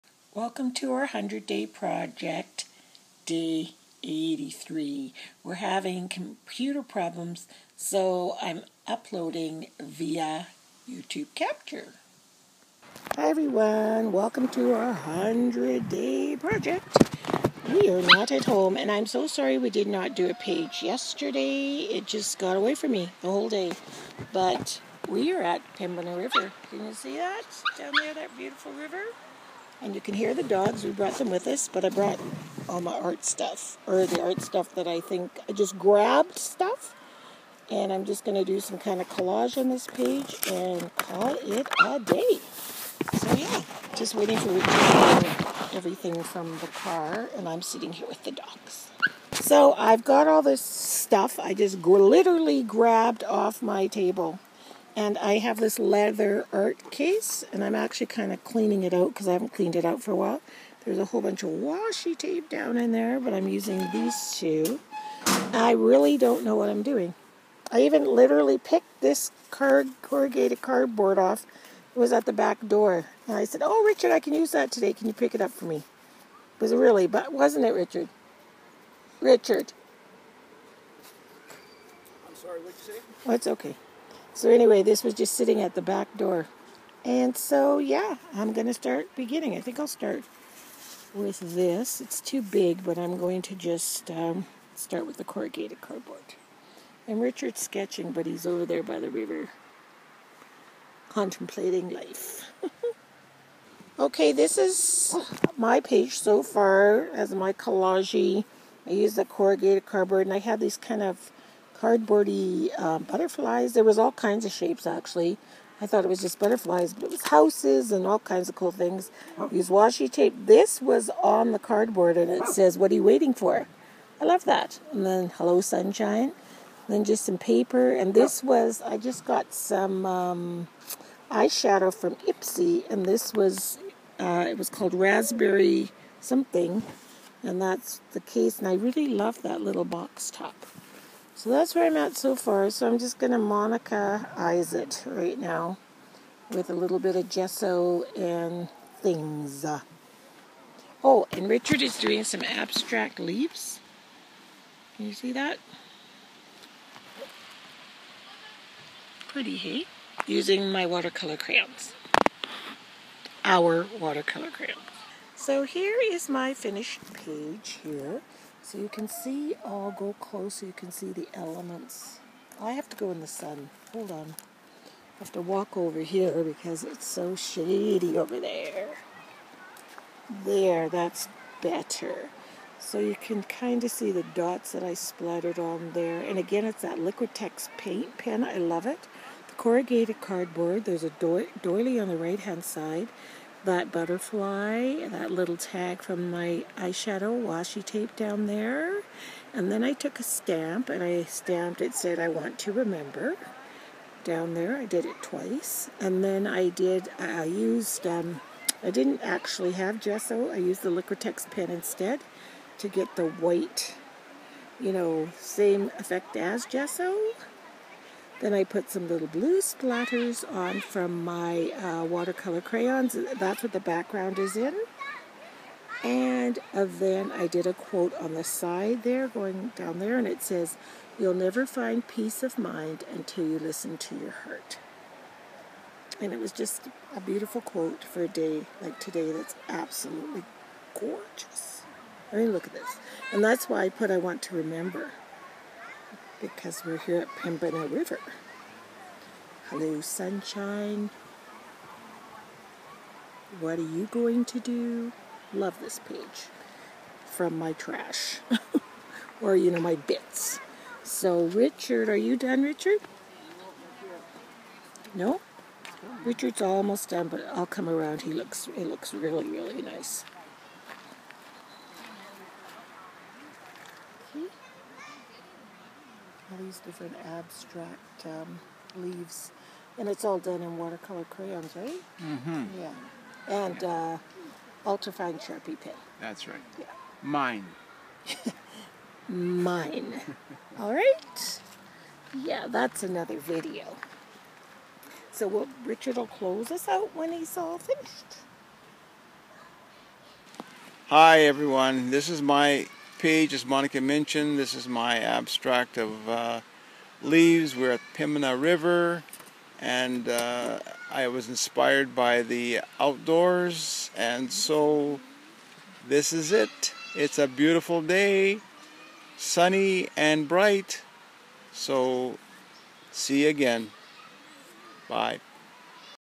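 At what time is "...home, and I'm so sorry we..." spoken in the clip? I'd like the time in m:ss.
0:18.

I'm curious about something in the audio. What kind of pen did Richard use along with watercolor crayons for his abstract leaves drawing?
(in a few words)
Ultrafine Sharpie.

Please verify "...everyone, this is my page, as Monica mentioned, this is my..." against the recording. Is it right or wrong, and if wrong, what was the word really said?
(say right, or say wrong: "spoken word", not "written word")
right.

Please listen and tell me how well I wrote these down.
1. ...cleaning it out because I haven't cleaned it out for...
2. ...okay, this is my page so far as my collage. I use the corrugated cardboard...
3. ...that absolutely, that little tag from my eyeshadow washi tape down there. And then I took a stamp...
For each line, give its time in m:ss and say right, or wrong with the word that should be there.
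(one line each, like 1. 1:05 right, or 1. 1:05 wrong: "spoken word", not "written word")
1. 0:58 right
2. 1:43 right
3. 3:13 wrong: "butterfly", not "absolutely".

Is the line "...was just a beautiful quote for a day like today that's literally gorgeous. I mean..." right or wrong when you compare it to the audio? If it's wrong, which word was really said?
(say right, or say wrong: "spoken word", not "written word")
wrong: "absolutely", not "literally".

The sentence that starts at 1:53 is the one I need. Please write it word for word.
There was all kinds of shapes actually.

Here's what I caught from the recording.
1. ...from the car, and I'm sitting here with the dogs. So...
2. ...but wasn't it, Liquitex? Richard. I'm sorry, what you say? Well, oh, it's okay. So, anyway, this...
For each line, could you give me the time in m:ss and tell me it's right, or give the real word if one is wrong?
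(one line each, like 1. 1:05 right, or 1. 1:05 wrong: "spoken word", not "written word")
1. 0:46 right
2. 1:17 wrong: "Richard", not "Liquitex".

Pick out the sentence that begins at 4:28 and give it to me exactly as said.
He looks, he looks really, really nice.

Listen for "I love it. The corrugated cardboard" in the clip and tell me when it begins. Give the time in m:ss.
3:08.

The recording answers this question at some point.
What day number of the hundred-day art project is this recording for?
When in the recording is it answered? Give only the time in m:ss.
0:03.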